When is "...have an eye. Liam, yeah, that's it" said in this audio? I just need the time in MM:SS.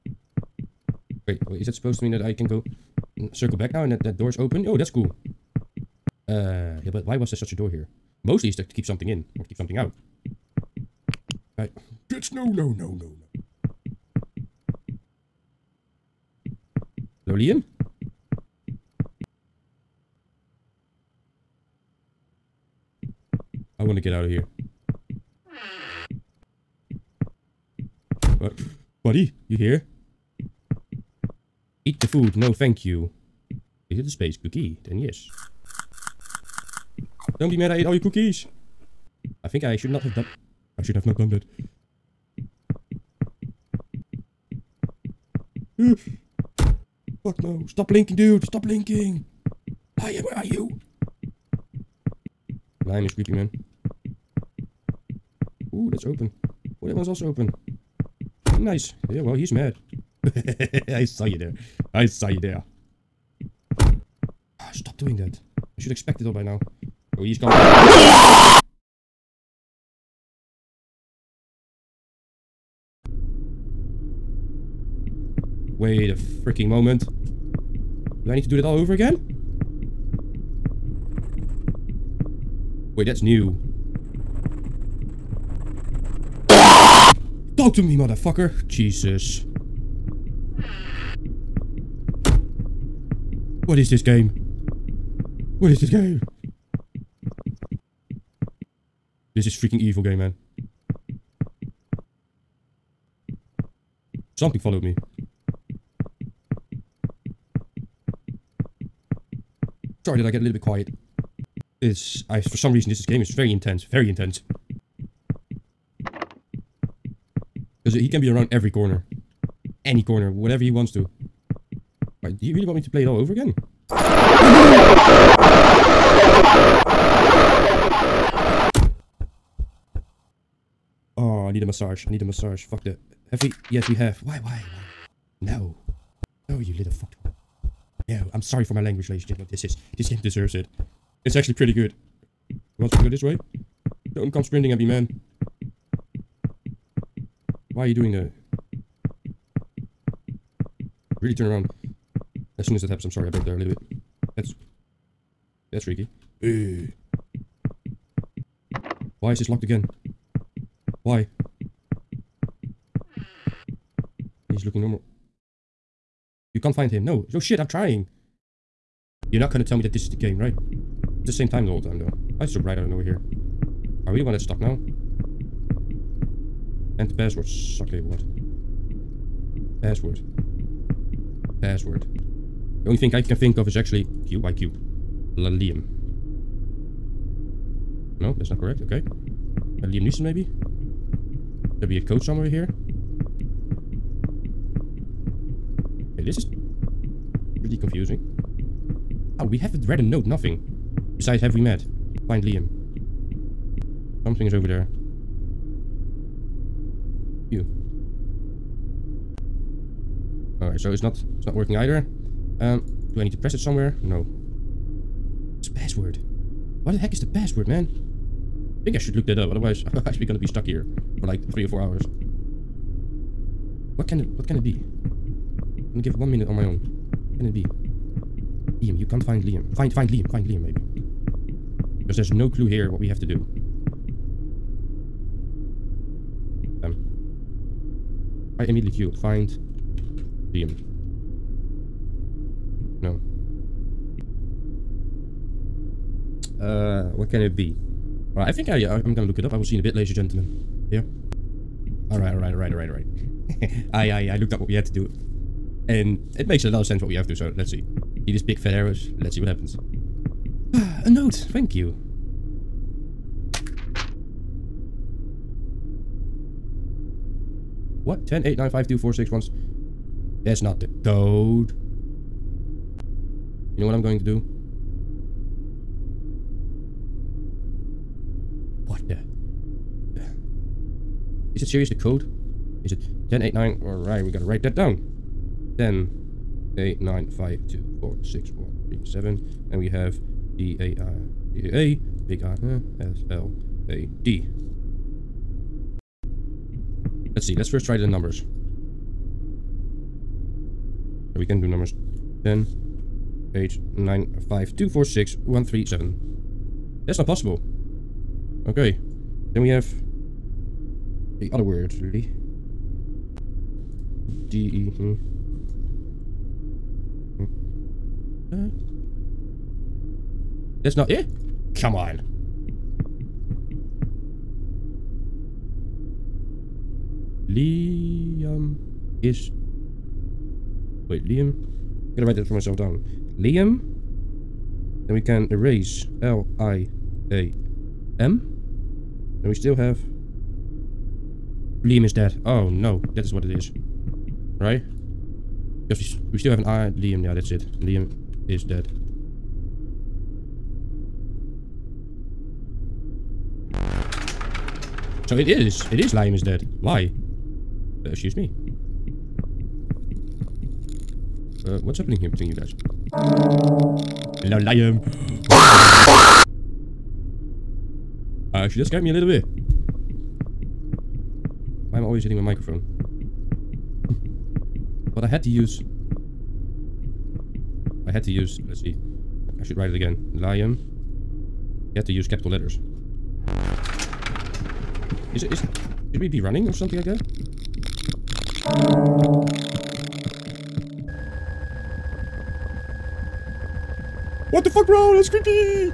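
05:46.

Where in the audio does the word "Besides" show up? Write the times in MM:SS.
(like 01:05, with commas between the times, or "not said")
03:21.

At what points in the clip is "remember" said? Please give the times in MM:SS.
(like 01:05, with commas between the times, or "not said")
not said.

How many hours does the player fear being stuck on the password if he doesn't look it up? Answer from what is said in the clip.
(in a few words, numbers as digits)
3 or 4 hours.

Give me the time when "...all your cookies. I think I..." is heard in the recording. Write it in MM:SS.
00:37.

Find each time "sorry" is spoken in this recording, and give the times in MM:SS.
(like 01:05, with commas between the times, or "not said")
01:50, 02:18, 02:33.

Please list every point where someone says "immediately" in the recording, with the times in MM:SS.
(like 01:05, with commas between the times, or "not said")
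03:58.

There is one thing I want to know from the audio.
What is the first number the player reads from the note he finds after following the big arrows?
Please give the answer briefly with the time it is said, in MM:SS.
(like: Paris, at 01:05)
10, at 04:28.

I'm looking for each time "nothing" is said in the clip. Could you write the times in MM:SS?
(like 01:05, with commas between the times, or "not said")
03:20.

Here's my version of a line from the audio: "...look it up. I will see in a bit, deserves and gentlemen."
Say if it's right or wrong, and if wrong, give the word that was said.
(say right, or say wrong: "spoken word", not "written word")
wrong: "ladies", not "deserves".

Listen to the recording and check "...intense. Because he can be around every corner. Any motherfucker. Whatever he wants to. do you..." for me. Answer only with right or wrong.
wrong.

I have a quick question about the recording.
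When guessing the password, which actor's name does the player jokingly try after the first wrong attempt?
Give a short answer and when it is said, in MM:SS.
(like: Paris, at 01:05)
Liam Neeson, at 03:09.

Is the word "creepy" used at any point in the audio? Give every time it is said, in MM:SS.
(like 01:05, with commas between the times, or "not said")
00:53, 06:35.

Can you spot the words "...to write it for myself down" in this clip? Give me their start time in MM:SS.
05:32.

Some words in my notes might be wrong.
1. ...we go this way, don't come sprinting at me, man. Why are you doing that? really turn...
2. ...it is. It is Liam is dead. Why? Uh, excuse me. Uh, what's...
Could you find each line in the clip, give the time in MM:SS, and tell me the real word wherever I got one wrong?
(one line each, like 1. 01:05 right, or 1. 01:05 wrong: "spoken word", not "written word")
1. 02:22 right
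2. 05:55 right.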